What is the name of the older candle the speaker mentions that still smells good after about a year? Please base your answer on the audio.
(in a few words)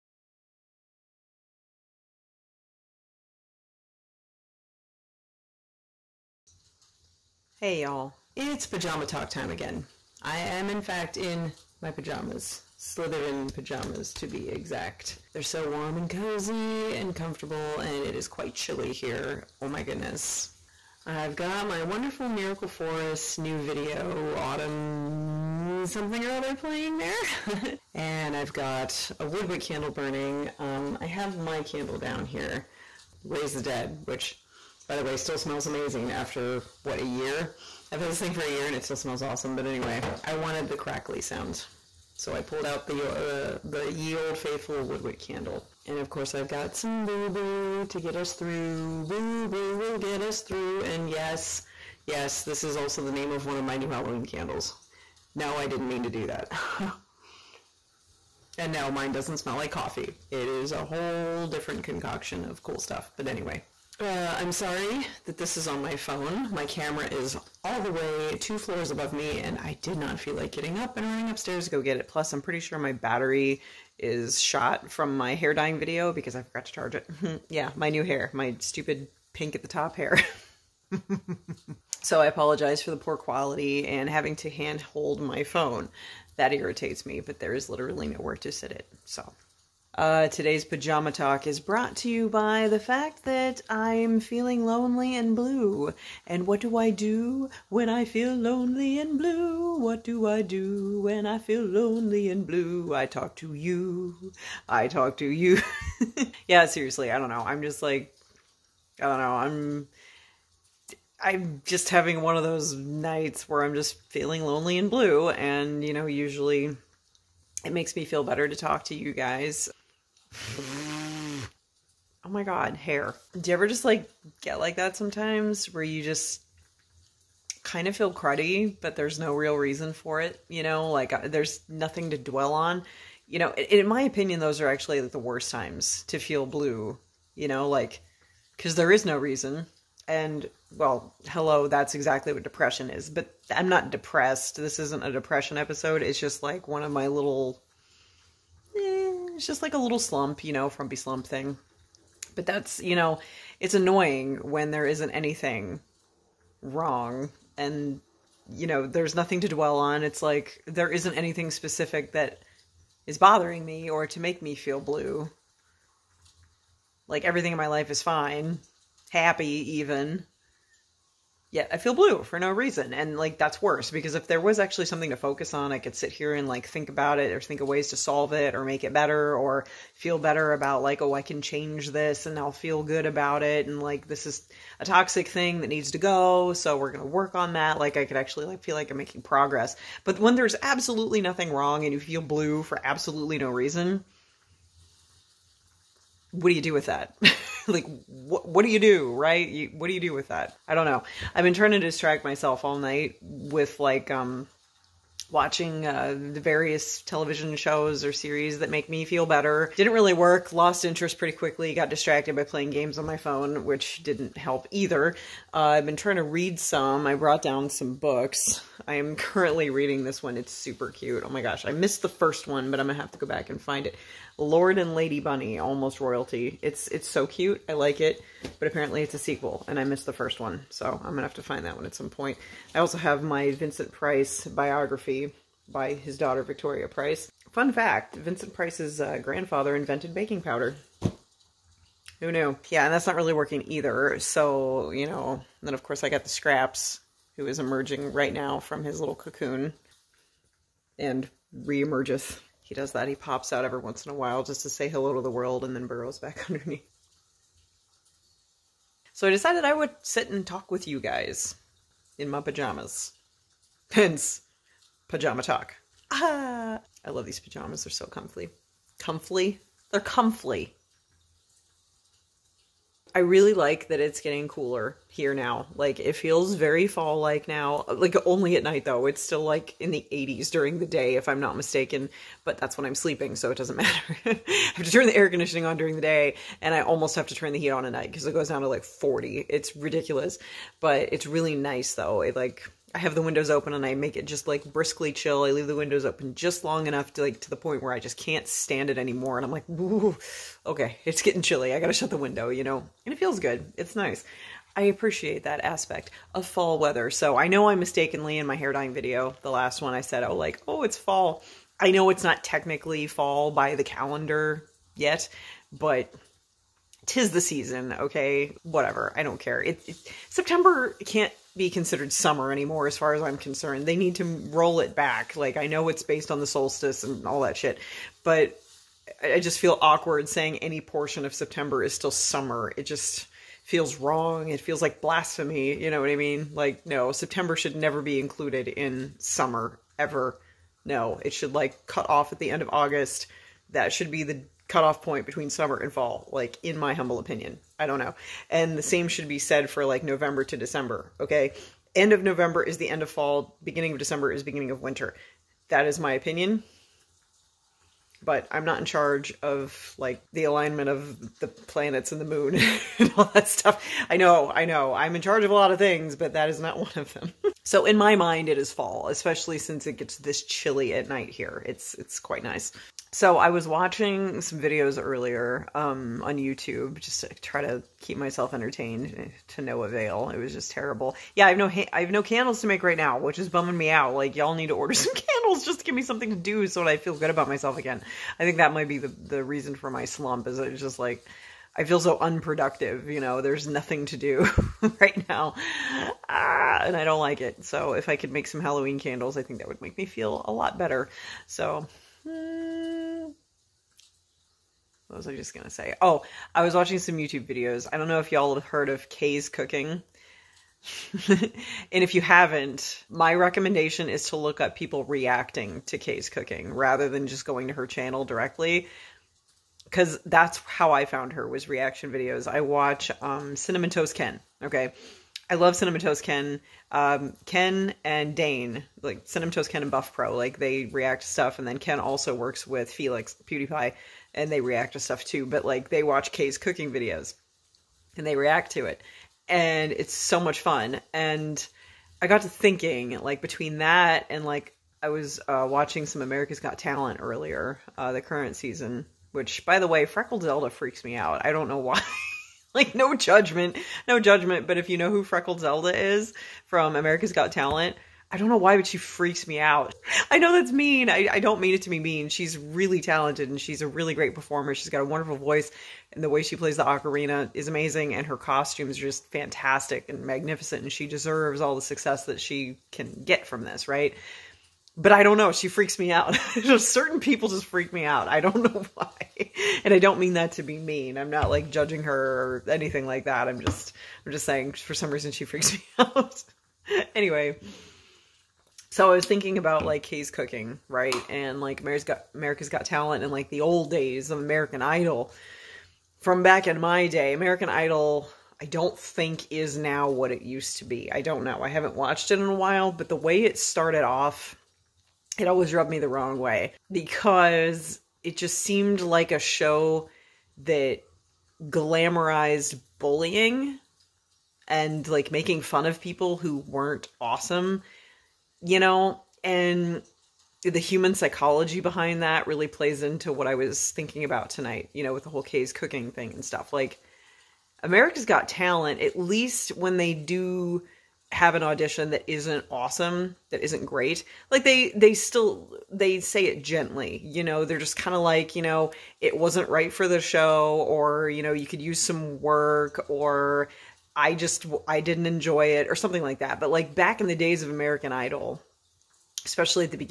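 Raise the Dead.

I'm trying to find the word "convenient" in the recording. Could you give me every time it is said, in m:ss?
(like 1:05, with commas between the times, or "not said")
not said.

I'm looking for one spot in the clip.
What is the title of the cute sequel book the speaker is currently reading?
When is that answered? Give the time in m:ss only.
3:44.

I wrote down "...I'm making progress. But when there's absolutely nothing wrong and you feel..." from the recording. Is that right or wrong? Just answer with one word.
right.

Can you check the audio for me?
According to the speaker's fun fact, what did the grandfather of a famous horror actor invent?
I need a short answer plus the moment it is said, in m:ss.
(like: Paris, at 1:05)
baking powder, at 4:00.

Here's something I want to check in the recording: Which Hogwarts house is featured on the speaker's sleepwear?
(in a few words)
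Slytherin.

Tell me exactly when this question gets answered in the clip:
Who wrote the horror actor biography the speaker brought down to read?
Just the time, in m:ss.
3:56.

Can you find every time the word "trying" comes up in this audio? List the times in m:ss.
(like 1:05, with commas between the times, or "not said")
3:21, 3:35.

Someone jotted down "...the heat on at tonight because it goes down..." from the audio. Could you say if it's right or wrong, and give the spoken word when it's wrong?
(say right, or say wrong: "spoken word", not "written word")
wrong: "night", not "tonight".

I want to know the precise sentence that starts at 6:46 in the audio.
Oh, I was watching some YouTube videos.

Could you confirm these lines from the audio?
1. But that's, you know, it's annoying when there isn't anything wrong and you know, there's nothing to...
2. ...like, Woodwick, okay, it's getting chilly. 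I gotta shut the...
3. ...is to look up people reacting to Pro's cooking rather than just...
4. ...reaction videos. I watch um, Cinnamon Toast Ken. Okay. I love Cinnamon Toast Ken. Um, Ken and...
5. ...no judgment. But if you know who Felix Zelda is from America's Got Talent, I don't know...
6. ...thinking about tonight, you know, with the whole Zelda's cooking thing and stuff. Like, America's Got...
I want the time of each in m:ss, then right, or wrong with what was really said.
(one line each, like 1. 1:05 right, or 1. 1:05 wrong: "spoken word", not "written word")
1. 2:32 right
2. 4:59 wrong: "Ooh", not "Woodwick"
3. 6:54 wrong: "Kay", not "Pro"
4. 7:01 right
5. 7:34 wrong: "Freckled", not "Felix"
6. 8:43 wrong: "Kay", not "Zelda".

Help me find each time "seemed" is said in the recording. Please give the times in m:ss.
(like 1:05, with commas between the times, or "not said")
8:28.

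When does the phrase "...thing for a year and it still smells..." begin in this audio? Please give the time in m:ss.
0:38.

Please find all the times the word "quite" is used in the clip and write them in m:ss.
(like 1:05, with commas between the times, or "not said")
0:18, 6:12.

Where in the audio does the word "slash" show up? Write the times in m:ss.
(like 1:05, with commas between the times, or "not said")
not said.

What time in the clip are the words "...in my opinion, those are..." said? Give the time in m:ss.
2:13.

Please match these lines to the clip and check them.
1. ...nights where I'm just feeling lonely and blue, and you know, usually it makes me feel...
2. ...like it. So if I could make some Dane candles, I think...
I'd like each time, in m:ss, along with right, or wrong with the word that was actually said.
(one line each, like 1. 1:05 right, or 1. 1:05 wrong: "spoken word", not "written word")
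1. 1:52 right
2. 6:37 wrong: "Halloween", not "Dane".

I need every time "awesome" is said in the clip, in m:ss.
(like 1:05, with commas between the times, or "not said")
0:39, 8:37, 8:52.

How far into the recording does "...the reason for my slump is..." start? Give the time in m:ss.
6:29.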